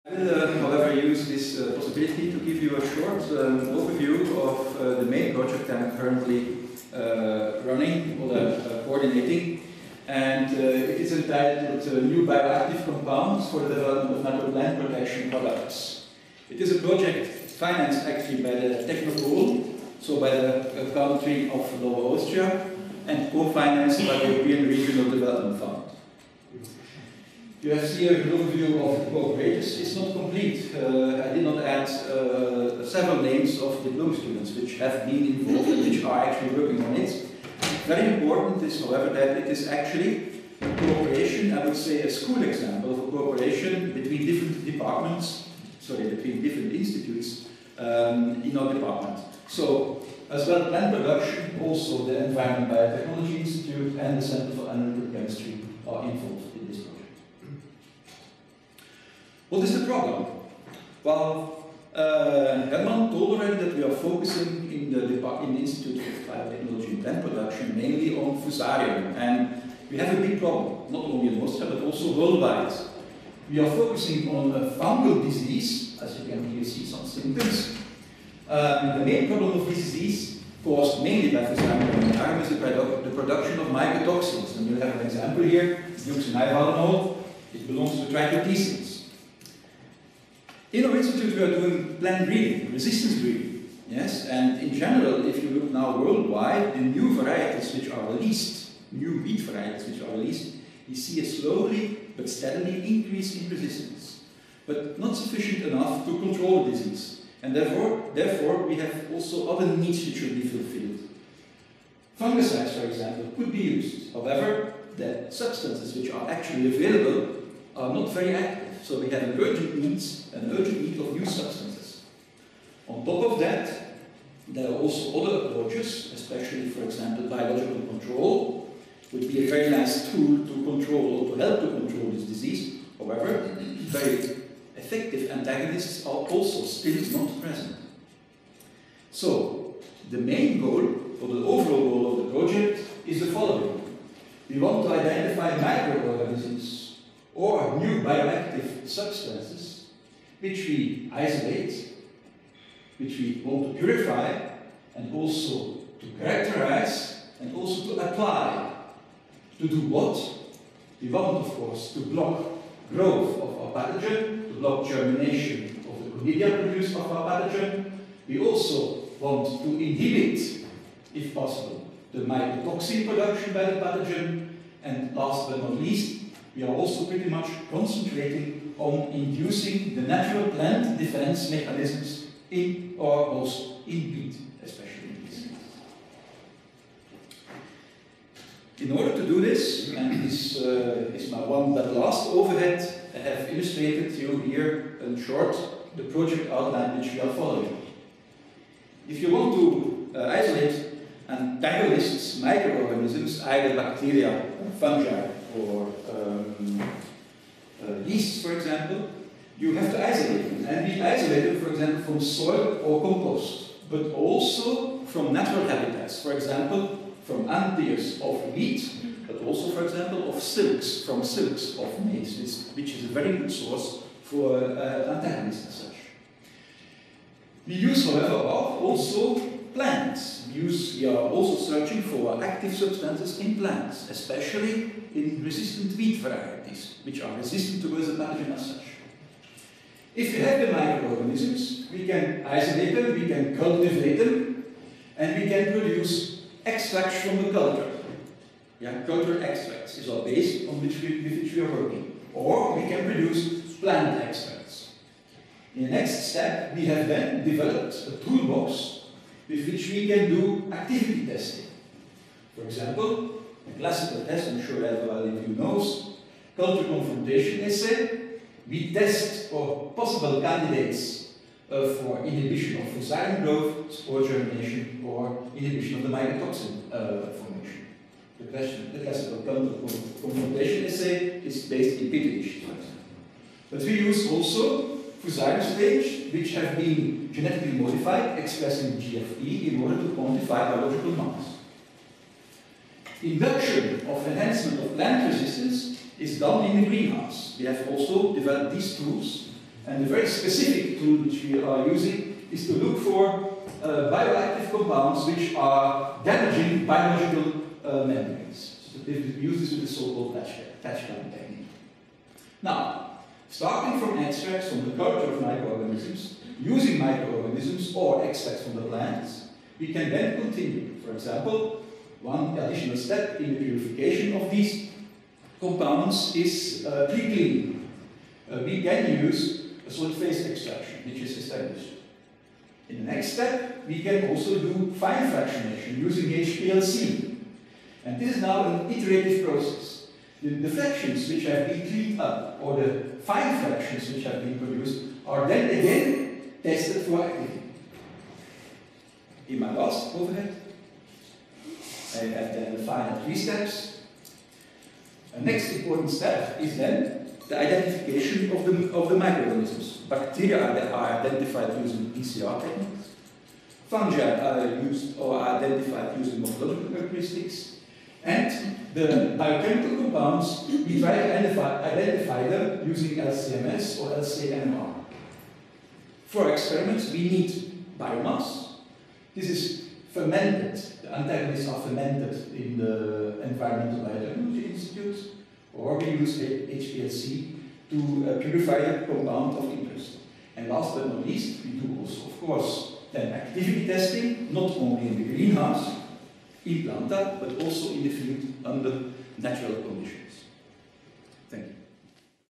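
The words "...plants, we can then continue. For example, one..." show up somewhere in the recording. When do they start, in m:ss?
5:18.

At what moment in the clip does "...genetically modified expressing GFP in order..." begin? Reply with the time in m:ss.
4:47.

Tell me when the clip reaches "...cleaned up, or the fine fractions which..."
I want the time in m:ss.
5:41.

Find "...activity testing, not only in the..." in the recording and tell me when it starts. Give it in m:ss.
6:33.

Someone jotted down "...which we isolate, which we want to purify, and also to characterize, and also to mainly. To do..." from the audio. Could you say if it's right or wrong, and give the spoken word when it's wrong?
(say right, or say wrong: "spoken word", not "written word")
wrong: "apply", not "mainly".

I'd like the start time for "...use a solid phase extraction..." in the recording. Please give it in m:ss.
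5:29.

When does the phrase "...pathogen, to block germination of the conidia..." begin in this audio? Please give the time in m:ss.
2:43.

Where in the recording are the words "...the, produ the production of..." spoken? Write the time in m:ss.
1:22.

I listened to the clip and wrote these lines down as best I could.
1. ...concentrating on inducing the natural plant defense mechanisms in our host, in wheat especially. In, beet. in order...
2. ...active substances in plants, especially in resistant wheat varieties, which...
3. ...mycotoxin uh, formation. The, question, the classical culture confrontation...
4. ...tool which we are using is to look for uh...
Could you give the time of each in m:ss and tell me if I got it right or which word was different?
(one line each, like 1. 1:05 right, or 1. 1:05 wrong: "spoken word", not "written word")
1. 2:57 right
2. 3:52 right
3. 4:36 right
4. 5:00 right.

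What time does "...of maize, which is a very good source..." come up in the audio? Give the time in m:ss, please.
3:41.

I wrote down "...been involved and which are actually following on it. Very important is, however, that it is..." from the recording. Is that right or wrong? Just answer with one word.
wrong.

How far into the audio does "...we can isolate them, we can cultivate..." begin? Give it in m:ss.
4:01.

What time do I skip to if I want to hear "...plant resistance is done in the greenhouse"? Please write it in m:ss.
4:54.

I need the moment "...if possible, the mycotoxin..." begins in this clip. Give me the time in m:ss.
2:51.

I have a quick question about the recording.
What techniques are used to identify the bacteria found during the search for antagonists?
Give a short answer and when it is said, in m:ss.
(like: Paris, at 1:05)
PCR techniques, at 6:02.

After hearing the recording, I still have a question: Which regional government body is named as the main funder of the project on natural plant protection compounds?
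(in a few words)
Technopol.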